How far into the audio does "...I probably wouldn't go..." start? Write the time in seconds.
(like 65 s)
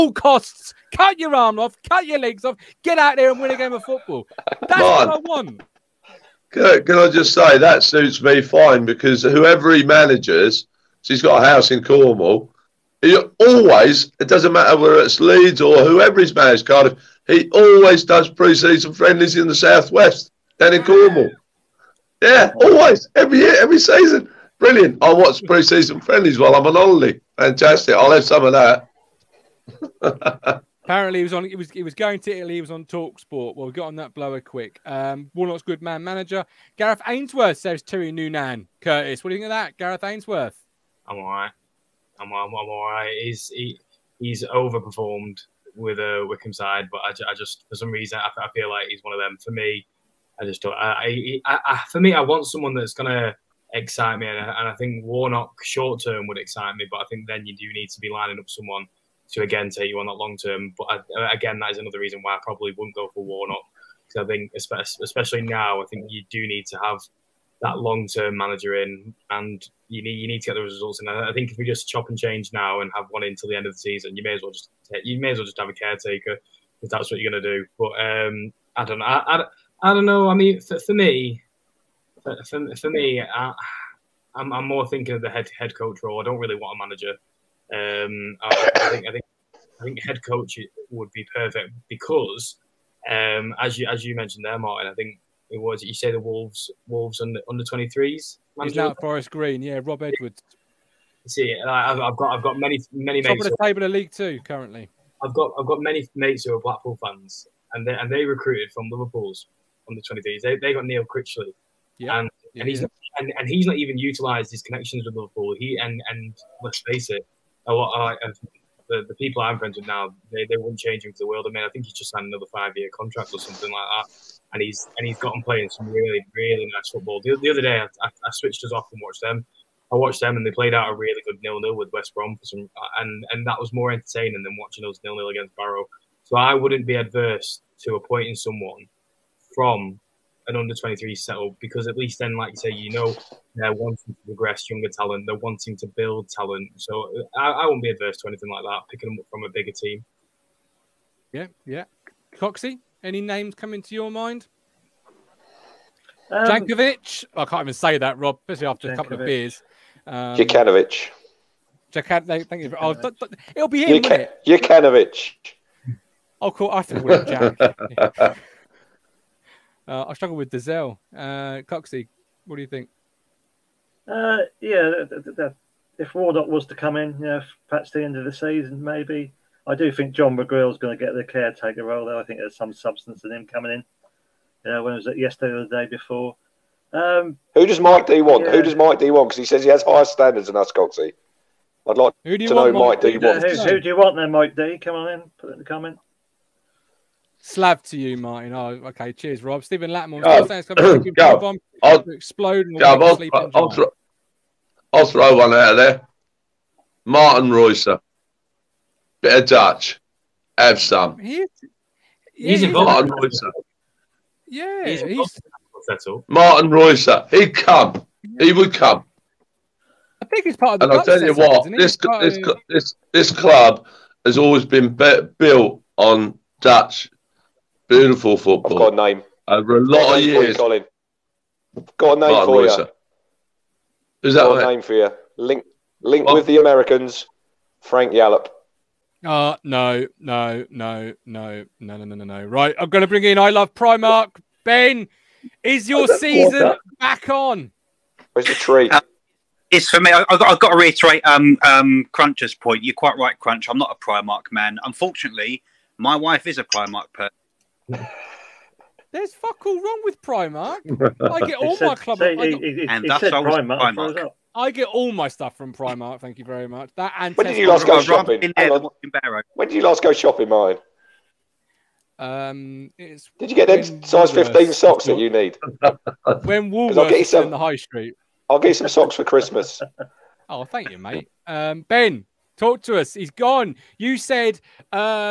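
62 s.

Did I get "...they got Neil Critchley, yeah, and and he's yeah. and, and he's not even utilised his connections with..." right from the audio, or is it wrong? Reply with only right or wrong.
right.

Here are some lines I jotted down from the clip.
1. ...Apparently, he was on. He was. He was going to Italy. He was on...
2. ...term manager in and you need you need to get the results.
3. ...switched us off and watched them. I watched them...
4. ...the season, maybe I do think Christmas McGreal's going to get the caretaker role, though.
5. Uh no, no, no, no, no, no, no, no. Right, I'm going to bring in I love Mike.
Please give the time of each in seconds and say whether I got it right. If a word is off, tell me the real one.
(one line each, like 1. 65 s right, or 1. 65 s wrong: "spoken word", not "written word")
1. 30 s right
2. 68 s right
3. 128 s right
4. 178 s wrong: "John", not "Christmas"
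5. 239 s wrong: "Primark", not "Mike".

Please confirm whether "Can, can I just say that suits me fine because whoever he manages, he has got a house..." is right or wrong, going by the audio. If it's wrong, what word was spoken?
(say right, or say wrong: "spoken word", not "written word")
right.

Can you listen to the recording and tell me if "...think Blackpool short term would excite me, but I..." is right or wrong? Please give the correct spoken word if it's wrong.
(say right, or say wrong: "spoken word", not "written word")
wrong: "Warnock", not "Blackpool".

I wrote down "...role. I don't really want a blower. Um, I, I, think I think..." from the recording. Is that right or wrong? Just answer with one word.
wrong.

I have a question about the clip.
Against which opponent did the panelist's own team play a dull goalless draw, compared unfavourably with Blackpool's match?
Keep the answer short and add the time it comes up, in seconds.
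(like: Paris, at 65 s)
Barrow, at 135 s.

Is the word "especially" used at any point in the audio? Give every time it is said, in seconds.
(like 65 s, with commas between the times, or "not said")
64 s, 158 s.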